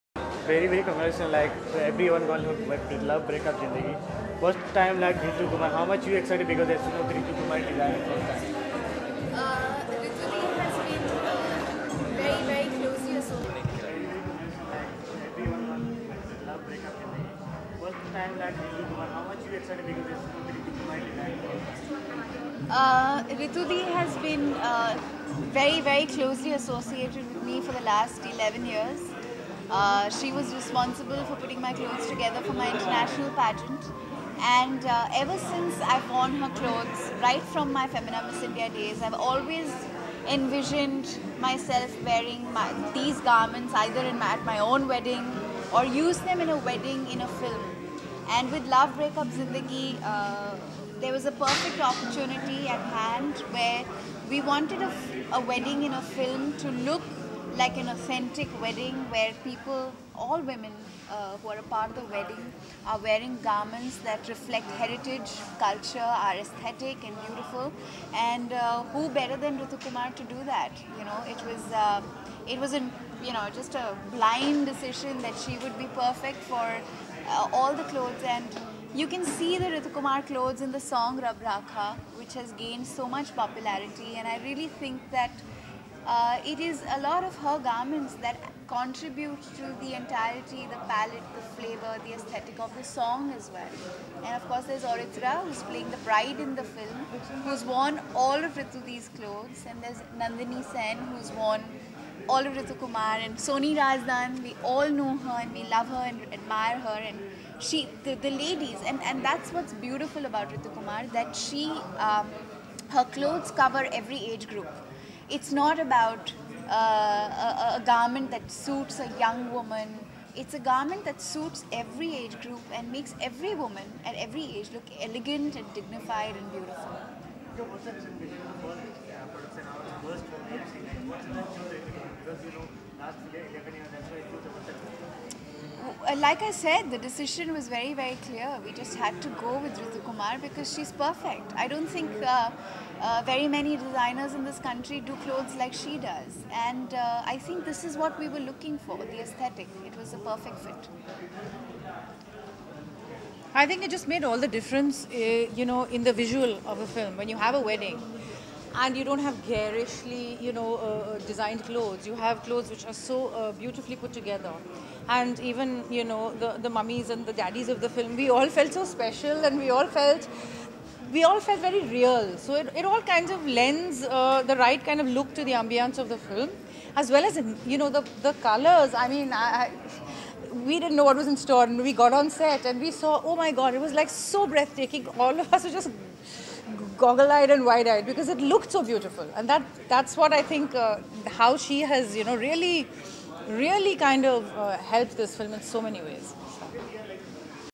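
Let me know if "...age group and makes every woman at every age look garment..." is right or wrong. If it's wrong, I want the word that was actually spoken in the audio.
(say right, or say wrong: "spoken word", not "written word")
wrong: "elegant", not "garment".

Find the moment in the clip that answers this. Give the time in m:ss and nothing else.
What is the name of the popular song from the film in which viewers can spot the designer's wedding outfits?
1:21.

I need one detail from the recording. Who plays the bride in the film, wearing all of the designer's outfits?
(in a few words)
Auritra.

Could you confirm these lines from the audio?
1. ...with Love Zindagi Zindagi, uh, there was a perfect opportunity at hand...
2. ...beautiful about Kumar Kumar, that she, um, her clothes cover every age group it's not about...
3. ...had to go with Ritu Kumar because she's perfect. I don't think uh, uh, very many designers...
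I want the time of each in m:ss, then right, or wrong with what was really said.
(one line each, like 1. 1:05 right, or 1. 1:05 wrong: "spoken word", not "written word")
1. 0:48 wrong: "Breakup", not "Zindagi"
2. 1:49 wrong: "Ritu", not "Kumar"
3. 2:18 right.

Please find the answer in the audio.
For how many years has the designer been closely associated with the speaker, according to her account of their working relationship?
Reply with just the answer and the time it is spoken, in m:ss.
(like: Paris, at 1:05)
11 years, at 0:28.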